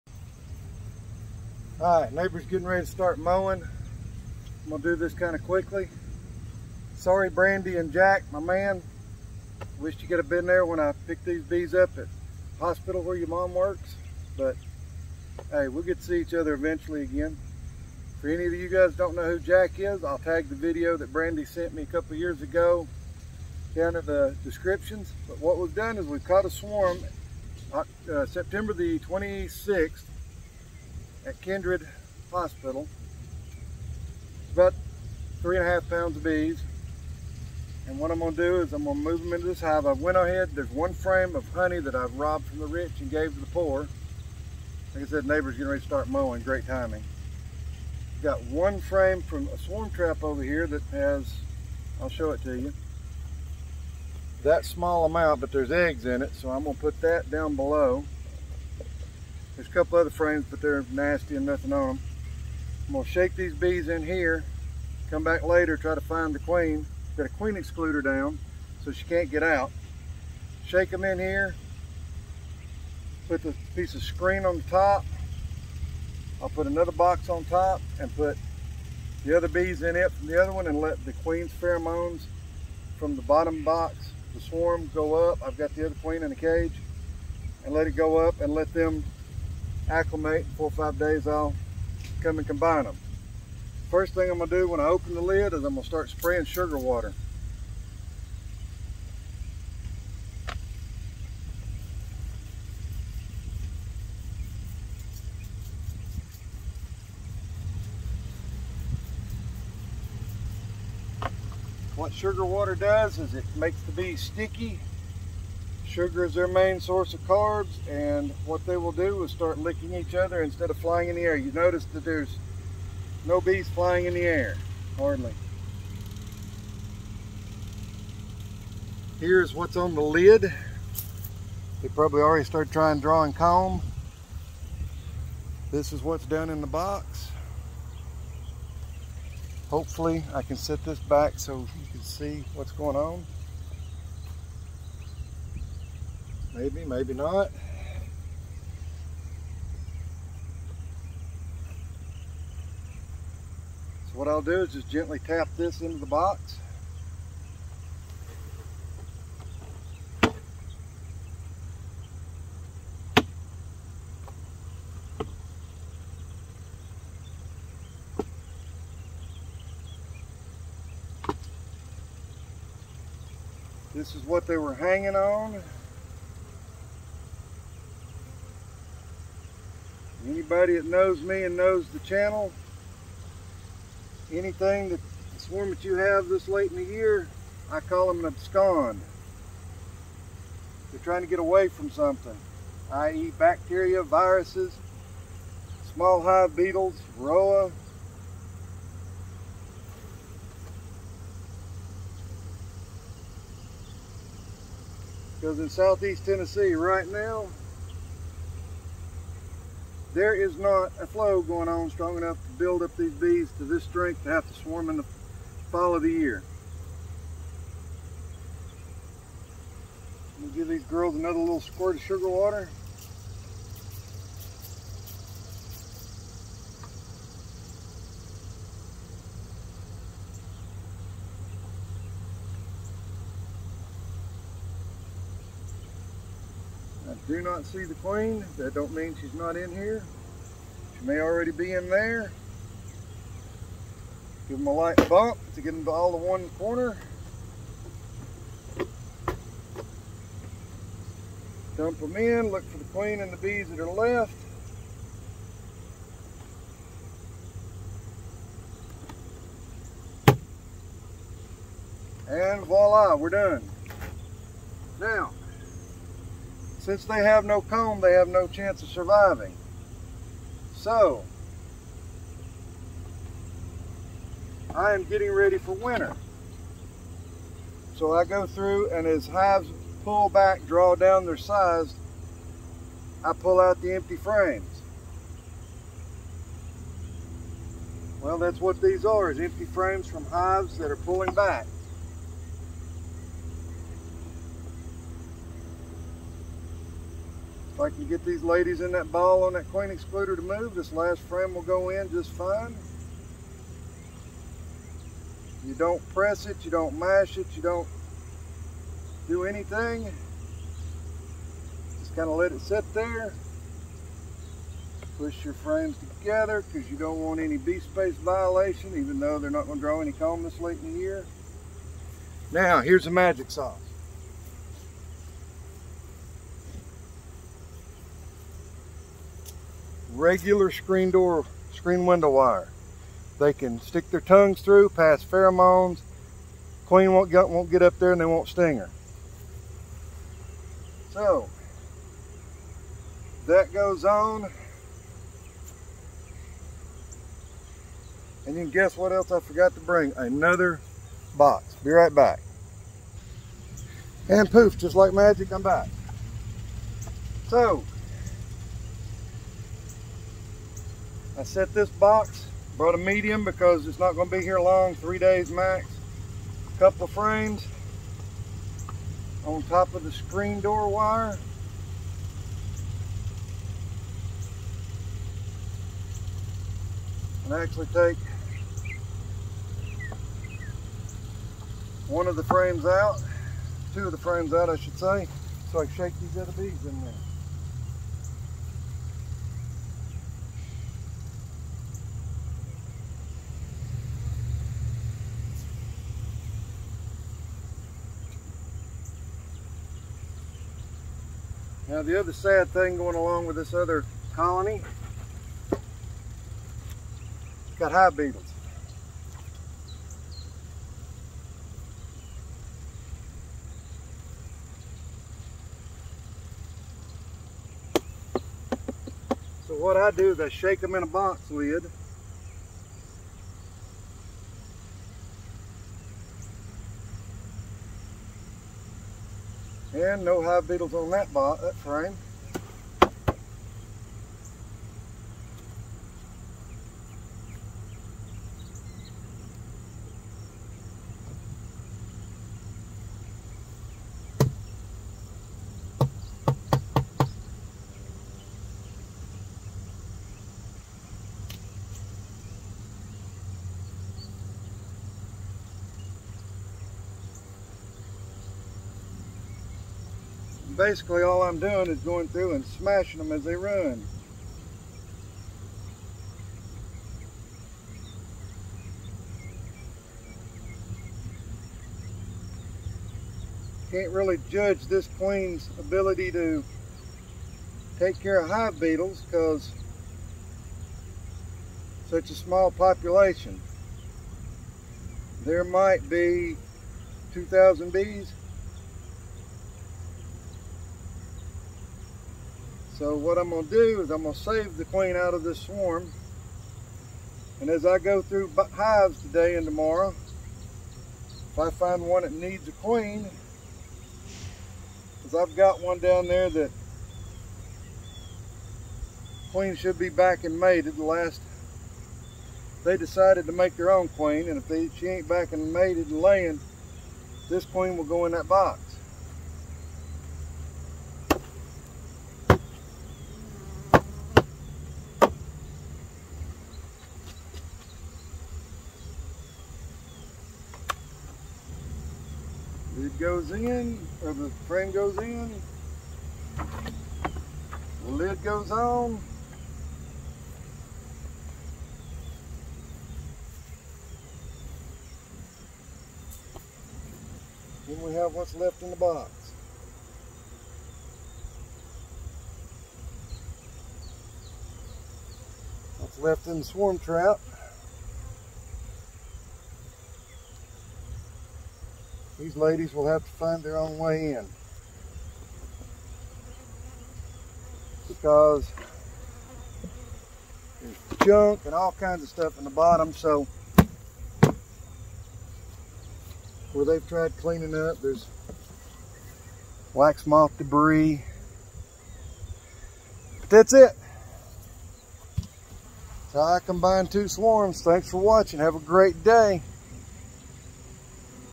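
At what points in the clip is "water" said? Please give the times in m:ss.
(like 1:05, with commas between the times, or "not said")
1:36, 1:52, 3:42.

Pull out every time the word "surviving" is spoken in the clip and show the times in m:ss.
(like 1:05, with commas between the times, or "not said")
4:28.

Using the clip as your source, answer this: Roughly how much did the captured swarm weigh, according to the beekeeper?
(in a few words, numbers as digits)
3.5 pounds.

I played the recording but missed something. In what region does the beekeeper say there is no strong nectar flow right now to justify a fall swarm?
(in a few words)
Southeast Tennessee.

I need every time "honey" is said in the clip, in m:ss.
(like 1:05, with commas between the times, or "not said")
0:41.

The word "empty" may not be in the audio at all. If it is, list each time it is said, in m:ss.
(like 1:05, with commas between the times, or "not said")
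4:43, 4:49.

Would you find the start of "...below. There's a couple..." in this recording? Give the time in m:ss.
0:57.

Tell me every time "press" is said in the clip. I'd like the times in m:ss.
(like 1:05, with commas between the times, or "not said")
5:06.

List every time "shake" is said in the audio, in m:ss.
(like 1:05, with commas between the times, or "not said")
1:03, 1:10, 6:25, 7:00.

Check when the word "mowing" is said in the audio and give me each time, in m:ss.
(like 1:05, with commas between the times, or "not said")
0:03, 0:46.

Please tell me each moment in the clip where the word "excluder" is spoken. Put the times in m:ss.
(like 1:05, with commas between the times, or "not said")
1:07, 4:59.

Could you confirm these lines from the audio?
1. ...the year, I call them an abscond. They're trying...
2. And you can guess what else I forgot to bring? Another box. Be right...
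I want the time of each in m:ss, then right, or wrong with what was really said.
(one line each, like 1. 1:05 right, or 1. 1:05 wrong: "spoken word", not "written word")
1. 3:06 right
2. 5:48 right.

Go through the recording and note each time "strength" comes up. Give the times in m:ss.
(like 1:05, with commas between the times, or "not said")
3:33.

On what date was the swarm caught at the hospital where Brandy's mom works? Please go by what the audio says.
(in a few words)
September 26.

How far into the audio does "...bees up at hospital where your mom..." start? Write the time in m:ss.
0:11.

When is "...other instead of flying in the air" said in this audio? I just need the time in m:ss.
2:00.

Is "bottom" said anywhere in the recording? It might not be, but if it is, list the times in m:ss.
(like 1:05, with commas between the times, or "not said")
1:23, 9:32.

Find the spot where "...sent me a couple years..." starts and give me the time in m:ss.
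0:21.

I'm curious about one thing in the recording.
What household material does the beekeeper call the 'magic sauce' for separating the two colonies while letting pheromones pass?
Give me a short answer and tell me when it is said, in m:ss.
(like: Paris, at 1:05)
Screen door wire, at 5:30.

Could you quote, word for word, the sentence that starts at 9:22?
These ladies will have to find their own way in.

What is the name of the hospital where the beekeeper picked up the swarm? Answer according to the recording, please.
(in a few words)
Kindred Hospital.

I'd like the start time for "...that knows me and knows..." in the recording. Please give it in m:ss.
3:00.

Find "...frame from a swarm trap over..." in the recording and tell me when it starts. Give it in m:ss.
0:48.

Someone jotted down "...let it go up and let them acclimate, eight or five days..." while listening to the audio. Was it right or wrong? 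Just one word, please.
wrong.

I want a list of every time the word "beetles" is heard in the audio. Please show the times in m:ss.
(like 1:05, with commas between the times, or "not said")
3:16, 6:48, 7:10, 7:58.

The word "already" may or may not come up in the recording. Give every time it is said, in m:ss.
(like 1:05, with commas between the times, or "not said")
2:12, 4:01.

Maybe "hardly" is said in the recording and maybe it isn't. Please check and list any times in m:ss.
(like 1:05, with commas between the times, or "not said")
2:04.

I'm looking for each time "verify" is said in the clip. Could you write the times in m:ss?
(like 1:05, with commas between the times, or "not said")
not said.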